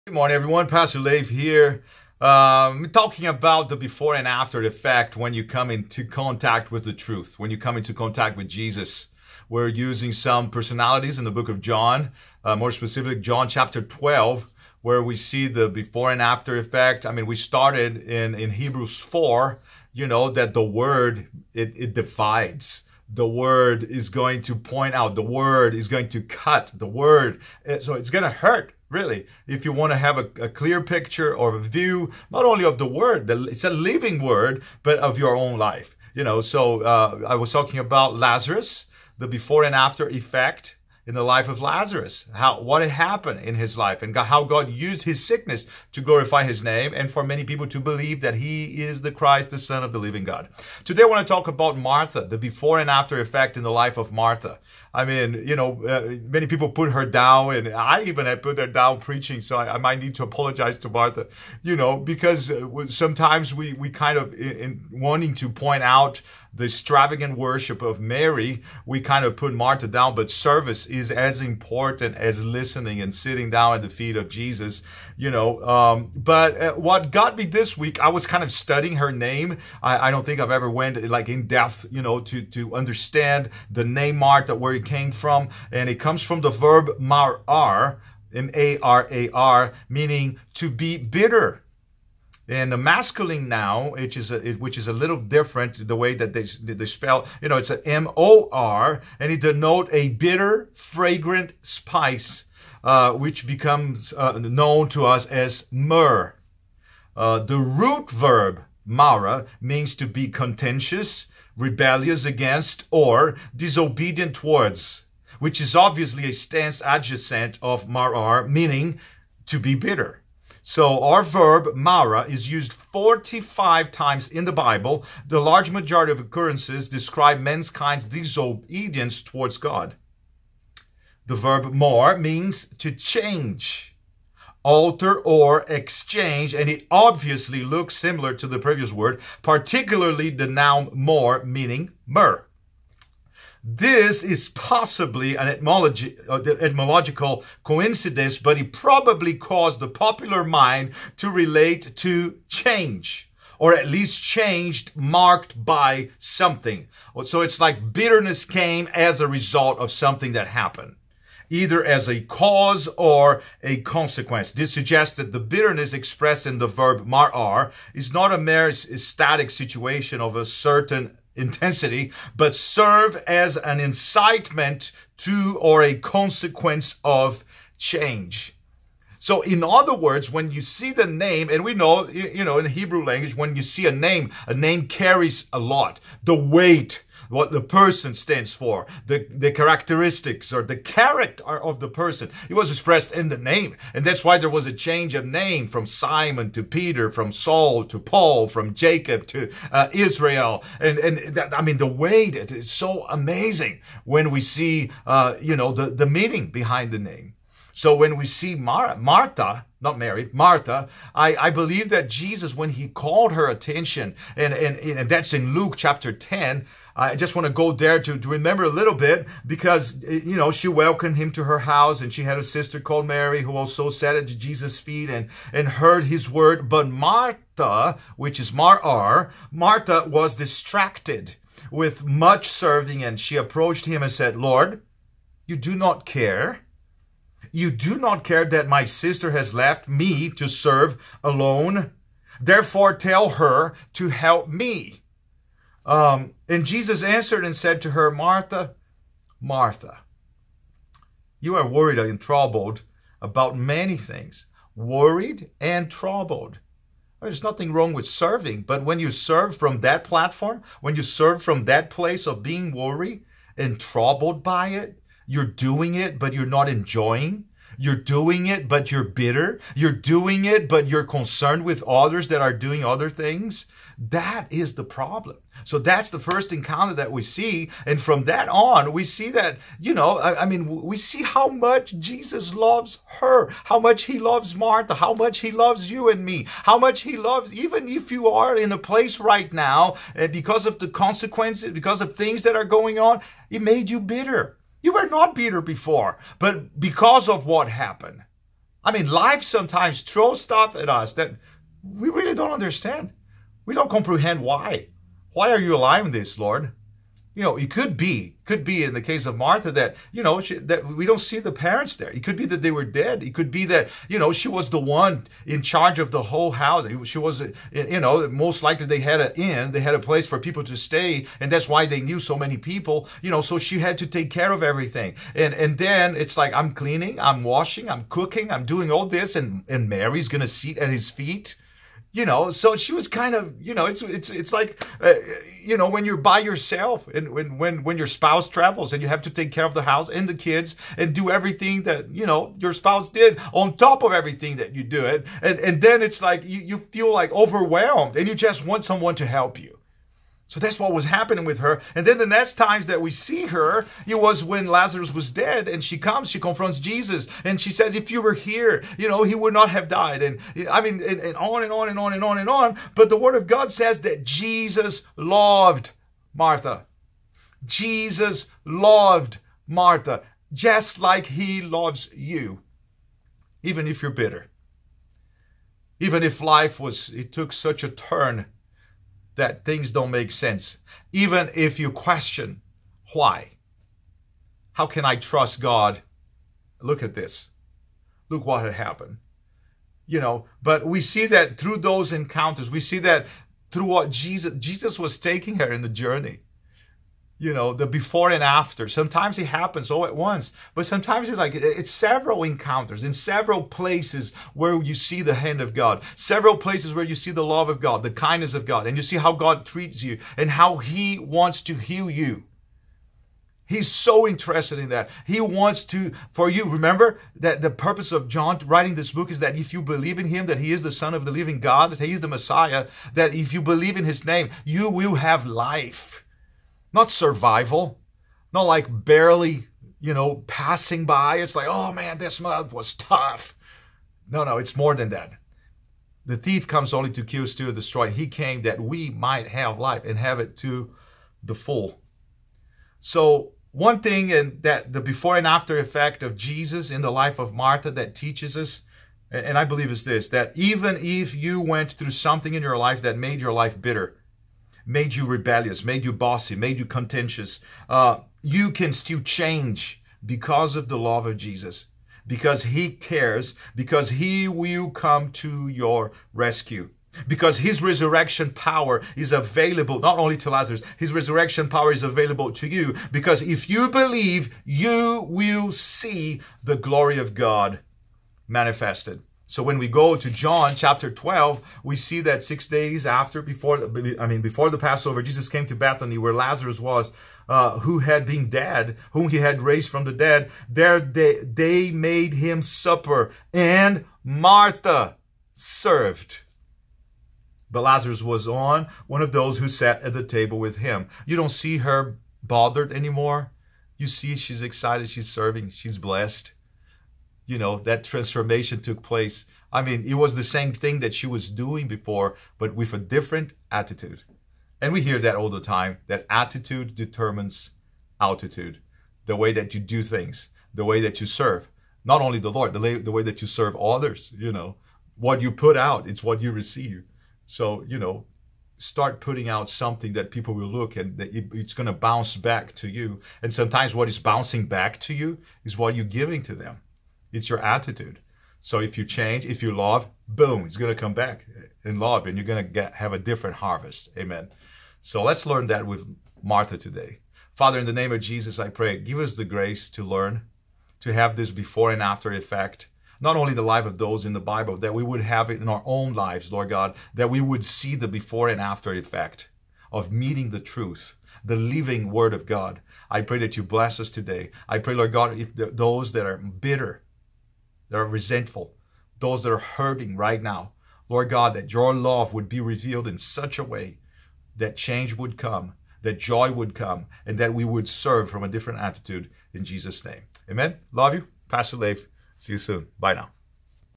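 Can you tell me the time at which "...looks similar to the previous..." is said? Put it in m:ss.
2:17.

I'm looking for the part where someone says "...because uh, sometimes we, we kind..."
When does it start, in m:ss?
1:01.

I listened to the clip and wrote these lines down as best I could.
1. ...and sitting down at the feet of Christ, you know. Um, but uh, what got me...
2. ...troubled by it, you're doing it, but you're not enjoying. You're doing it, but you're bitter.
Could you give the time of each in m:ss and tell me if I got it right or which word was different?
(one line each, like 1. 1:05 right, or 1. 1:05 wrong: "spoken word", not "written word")
1. 1:13 wrong: "Jesus", not "Christ"
2. 4:23 right.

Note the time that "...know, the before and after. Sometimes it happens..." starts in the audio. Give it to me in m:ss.
6:37.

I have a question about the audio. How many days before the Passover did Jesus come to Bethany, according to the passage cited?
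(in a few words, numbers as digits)
6.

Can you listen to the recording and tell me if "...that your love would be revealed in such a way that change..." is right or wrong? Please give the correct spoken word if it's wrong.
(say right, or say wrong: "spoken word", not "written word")
right.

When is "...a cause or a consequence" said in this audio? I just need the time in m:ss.
2:42.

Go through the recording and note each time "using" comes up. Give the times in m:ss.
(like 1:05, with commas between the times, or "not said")
0:09.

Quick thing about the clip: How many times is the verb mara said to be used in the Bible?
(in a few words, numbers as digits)
45.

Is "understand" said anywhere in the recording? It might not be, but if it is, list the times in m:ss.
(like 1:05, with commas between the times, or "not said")
1:22, 5:02.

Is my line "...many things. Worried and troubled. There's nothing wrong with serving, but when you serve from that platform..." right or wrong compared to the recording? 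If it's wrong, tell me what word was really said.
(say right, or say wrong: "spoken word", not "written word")
right.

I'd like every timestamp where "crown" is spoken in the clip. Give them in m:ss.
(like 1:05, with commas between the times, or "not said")
not said.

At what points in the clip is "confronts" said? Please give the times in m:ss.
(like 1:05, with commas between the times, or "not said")
5:56.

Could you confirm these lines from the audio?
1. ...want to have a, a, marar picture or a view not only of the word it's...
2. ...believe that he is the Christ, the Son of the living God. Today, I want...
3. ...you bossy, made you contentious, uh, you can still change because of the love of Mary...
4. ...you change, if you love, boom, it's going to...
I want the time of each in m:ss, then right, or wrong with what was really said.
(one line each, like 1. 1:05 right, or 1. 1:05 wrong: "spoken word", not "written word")
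1. 0:29 wrong: "clear", not "marar"
2. 0:47 right
3. 7:36 wrong: "Jesus", not "Mary"
4. 8:58 right.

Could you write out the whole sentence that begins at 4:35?
So that's the first encounter that we see.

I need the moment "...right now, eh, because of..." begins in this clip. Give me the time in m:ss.
4:49.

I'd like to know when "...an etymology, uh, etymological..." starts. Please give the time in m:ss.
2:25.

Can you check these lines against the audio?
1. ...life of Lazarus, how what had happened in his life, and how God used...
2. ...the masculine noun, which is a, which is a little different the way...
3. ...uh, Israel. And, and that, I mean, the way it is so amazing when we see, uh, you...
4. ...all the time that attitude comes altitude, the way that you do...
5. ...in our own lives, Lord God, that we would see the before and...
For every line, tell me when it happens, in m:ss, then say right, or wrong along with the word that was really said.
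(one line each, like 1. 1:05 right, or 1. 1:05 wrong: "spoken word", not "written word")
1. 0:41 right
2. 1:32 right
3. 3:19 right
4. 8:35 wrong: "determines", not "comes"
5. 9:15 right.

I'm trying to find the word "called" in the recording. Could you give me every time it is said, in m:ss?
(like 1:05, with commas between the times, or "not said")
3:32, 3:42.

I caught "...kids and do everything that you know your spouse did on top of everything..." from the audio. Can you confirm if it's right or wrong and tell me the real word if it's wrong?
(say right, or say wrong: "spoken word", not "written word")
right.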